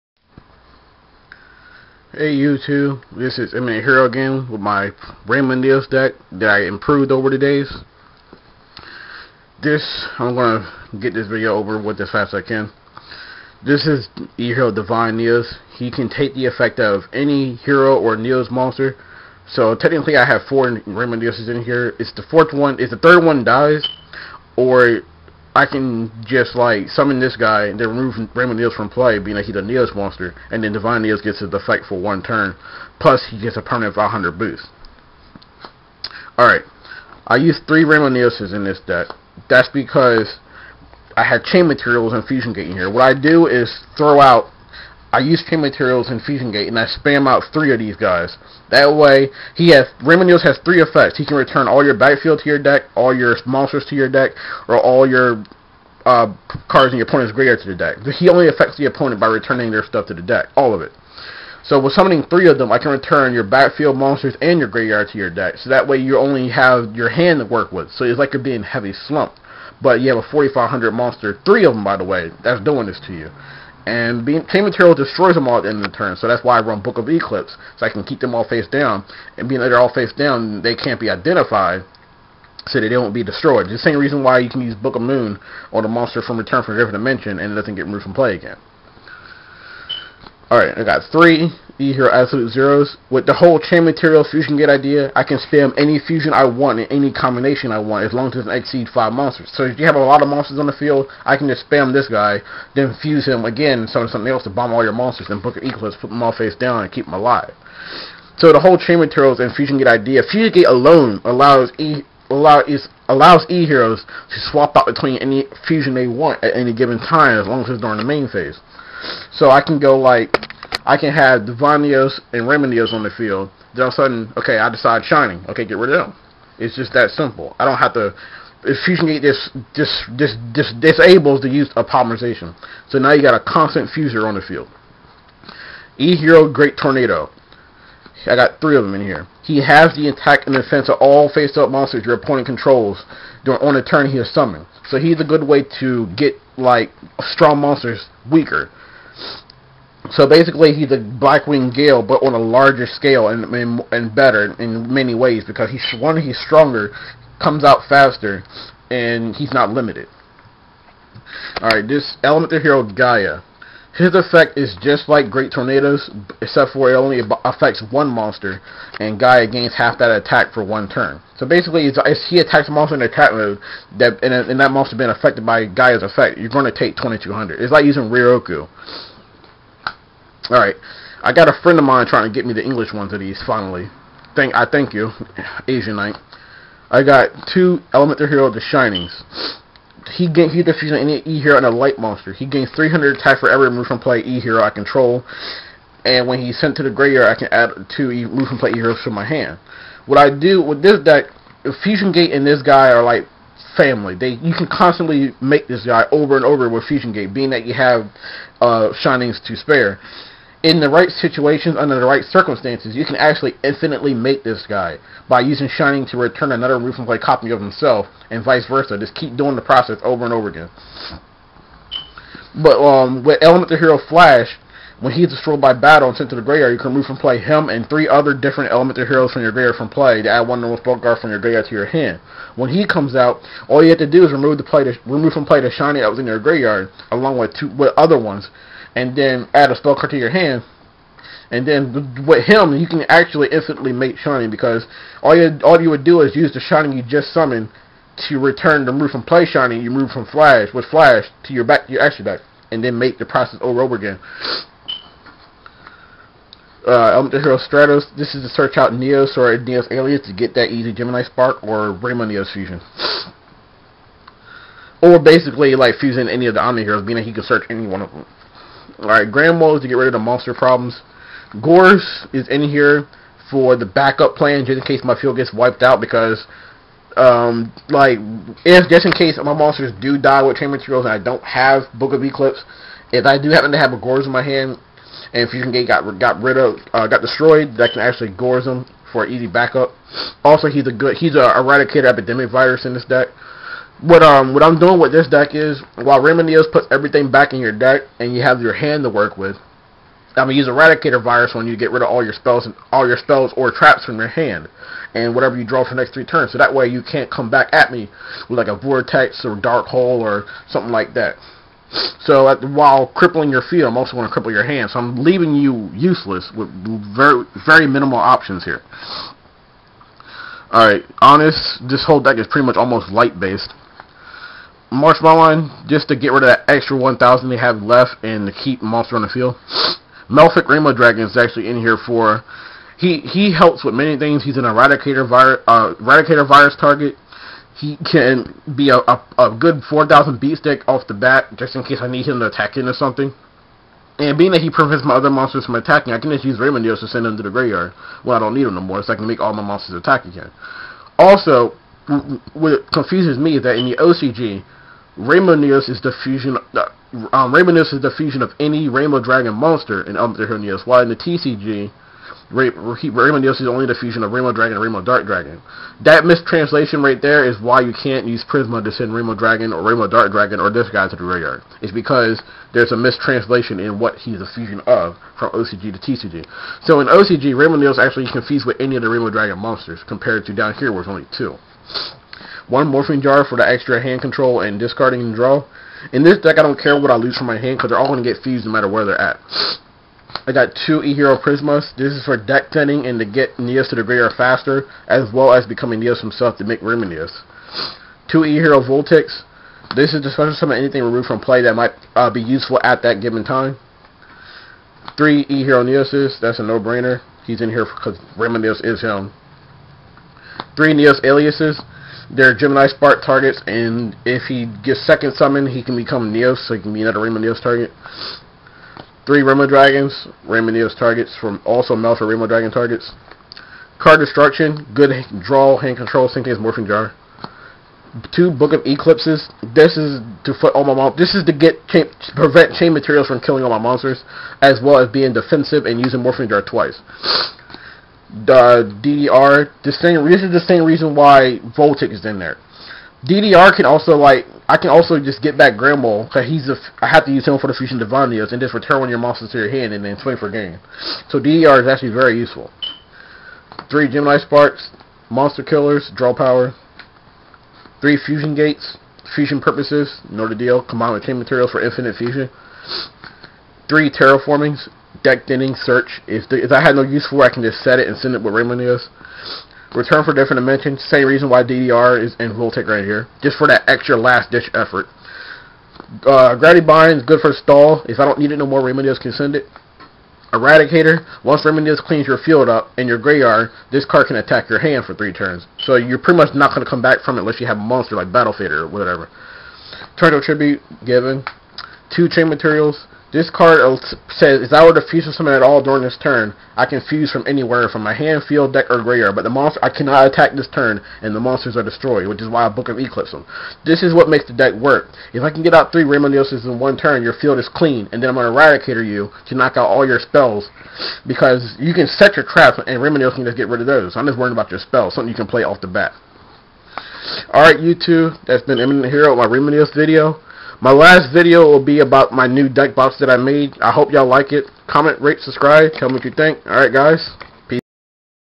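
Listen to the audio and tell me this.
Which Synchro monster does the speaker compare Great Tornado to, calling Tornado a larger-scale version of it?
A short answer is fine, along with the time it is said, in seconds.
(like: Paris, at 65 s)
Blackwing Gale, at 150 s.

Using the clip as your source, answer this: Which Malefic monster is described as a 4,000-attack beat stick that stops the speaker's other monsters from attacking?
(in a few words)
Malefic Rainbow Dragon.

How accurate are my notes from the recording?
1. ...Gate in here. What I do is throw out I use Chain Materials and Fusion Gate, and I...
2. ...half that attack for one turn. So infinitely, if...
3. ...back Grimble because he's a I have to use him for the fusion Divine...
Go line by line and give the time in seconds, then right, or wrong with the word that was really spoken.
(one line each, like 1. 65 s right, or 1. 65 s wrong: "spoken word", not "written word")
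1. 42 s right
2. 169 s wrong: "basically", not "infinitely"
3. 445 s right.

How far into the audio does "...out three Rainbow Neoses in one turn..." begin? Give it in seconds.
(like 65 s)
505 s.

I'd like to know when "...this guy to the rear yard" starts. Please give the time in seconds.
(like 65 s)
370 s.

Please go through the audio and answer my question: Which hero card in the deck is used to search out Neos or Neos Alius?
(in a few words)
Stratos.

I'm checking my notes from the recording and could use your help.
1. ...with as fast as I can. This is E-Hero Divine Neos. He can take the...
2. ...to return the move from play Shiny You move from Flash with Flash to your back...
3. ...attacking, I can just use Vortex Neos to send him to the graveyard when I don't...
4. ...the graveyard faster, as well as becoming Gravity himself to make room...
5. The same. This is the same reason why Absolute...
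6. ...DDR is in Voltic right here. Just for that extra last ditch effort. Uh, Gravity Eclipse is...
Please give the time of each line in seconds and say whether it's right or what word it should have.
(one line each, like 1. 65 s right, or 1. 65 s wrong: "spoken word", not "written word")
1. 11 s right
2. 248 s right
3. 345 s wrong: "Rainbow", not "Vortex"
4. 393 s wrong: "Neos", not "Gravity"
5. 439 s wrong: "Voltic", not "Absolute"
6. 471 s wrong: "Bind", not "Eclipse".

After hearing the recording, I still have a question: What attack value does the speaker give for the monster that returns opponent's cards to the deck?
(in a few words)
4,500.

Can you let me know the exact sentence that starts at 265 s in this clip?
Or basically like fusing any of the Omni heroes, meaning he can search any one of them.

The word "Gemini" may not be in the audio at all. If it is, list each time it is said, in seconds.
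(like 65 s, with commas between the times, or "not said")
260 s, 412 s, 454 s.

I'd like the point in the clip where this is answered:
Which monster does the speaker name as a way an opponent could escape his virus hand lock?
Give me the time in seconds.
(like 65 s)
488 s.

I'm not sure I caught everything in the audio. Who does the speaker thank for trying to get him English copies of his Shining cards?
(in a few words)
Asian Knight.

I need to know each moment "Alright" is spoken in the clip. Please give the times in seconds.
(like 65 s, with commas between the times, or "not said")
36 s, 90 s, 180 s, 269 s, 517 s, 526 s.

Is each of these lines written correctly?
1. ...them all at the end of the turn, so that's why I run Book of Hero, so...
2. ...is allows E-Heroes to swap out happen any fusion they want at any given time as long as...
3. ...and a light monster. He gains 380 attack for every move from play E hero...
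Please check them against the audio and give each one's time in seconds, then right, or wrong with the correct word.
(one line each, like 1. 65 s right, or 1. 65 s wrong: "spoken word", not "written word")
1. 75 s wrong: "Eclipse", not "Hero"
2. 112 s wrong: "between", not "happen"
3. 191 s wrong: "300", not "380".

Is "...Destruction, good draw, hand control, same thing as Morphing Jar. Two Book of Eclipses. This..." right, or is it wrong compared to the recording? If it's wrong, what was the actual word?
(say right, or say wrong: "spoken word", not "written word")
right.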